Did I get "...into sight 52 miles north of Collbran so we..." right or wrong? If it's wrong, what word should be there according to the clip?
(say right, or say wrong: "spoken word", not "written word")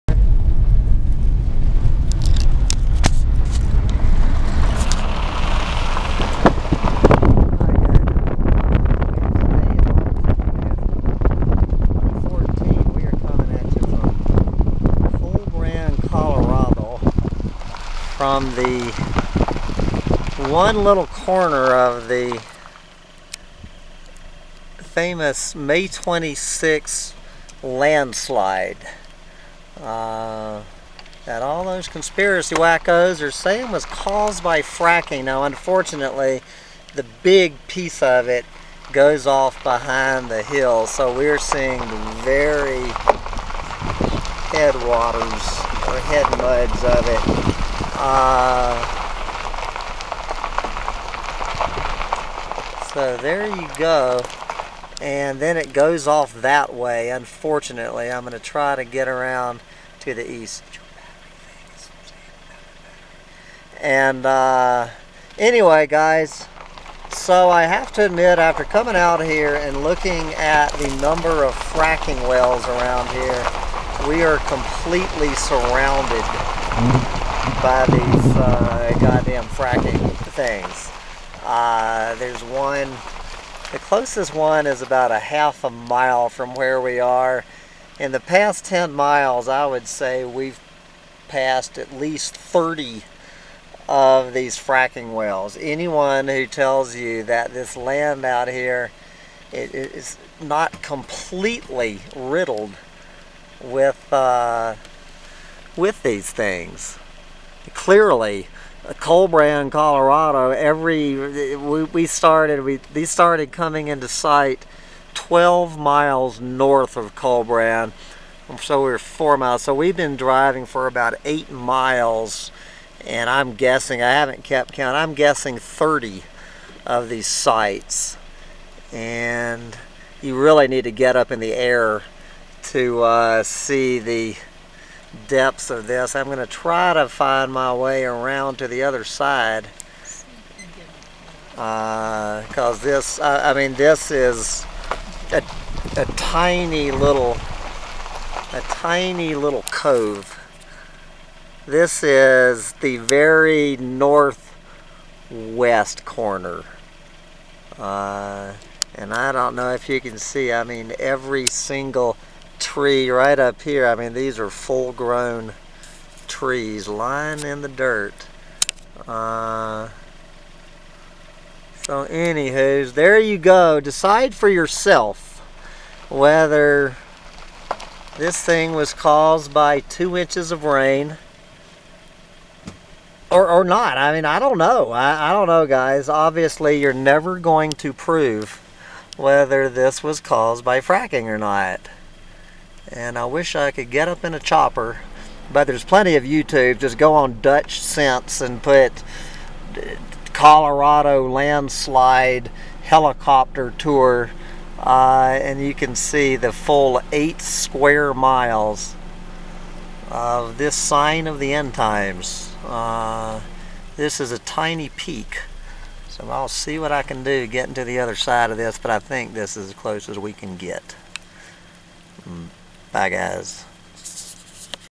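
wrong: "12", not "52".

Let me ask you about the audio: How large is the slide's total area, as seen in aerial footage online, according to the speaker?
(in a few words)
8 square miles.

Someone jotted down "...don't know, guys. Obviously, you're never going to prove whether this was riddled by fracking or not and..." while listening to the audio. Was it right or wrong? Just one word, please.
wrong.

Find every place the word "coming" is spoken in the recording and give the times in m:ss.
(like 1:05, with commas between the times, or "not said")
1:08, 1:53.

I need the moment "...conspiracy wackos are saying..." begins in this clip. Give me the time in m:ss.
0:31.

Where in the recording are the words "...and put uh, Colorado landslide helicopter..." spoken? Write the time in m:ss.
3:18.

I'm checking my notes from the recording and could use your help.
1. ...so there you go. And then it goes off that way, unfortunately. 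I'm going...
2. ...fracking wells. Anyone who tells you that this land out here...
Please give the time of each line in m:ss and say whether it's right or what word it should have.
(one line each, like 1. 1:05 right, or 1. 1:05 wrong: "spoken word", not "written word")
1. 0:52 right
2. 1:34 right.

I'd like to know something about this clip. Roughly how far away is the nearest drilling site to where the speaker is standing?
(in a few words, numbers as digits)
Half a mile.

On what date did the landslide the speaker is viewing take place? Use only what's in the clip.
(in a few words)
May 26.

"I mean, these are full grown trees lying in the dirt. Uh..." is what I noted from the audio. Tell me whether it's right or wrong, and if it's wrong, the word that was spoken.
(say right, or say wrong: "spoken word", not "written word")
right.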